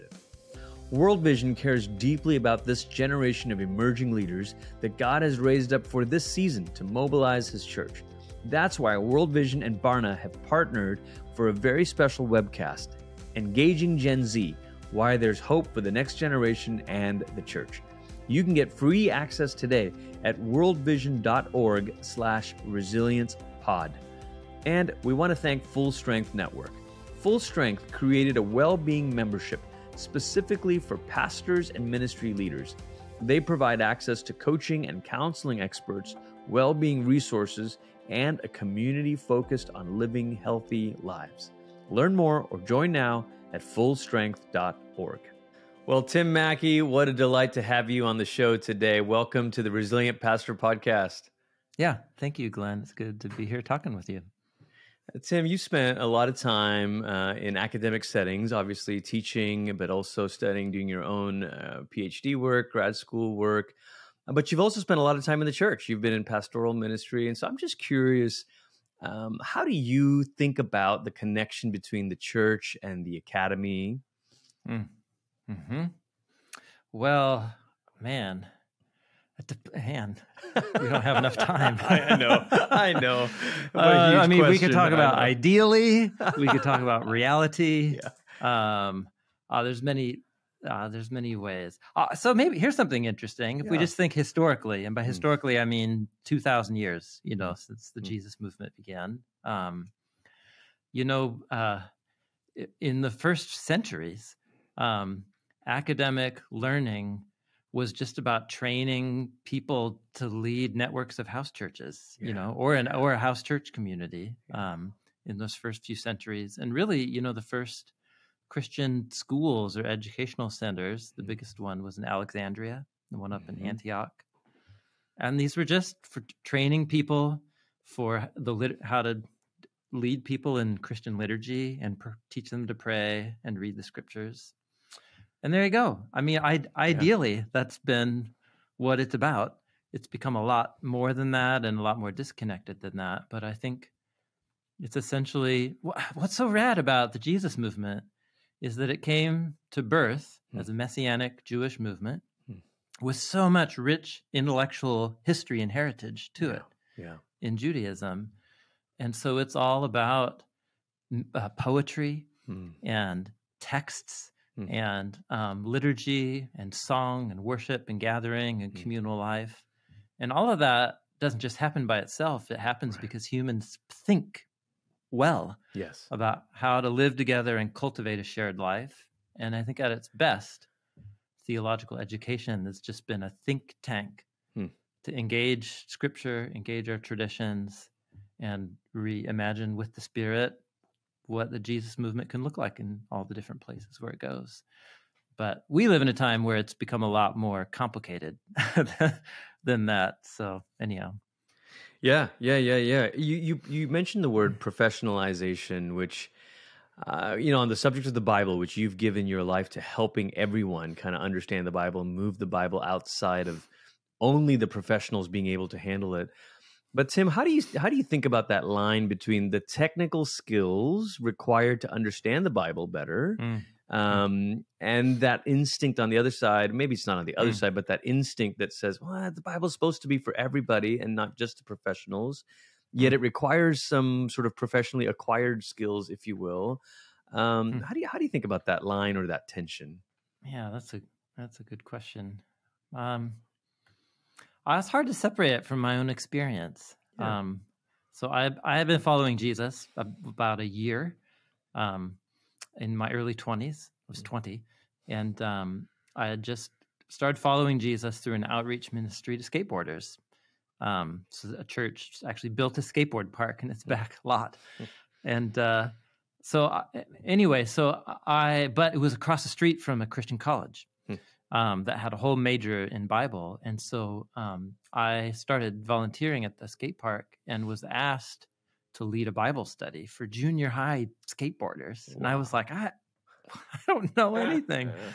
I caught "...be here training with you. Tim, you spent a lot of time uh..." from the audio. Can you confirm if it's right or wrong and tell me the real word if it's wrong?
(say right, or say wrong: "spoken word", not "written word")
wrong: "talking", not "training".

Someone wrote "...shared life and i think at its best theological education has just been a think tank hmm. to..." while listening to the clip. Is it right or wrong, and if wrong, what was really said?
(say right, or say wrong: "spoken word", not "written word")
right.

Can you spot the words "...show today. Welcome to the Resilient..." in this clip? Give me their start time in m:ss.
0:48.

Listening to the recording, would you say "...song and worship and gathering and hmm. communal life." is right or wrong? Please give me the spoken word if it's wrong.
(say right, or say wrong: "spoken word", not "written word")
right.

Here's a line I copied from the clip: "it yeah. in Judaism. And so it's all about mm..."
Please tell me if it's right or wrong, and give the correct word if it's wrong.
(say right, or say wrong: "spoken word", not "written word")
right.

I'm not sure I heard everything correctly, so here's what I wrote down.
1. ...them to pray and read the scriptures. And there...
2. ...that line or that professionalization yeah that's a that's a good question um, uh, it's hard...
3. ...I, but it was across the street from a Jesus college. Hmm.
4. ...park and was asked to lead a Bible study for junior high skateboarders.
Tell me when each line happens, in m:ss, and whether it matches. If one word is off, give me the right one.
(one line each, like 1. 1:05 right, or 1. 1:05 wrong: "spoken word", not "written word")
1. 2:12 right
2. 3:58 wrong: "tension", not "professionalization"
3. 4:28 wrong: "Christian", not "Jesus"
4. 4:36 right.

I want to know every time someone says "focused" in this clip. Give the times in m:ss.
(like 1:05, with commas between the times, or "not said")
0:39.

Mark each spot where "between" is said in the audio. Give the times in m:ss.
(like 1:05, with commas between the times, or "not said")
1:11, 3:39.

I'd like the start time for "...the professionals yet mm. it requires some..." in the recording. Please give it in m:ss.
3:51.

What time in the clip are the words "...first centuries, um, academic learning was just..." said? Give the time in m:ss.
1:43.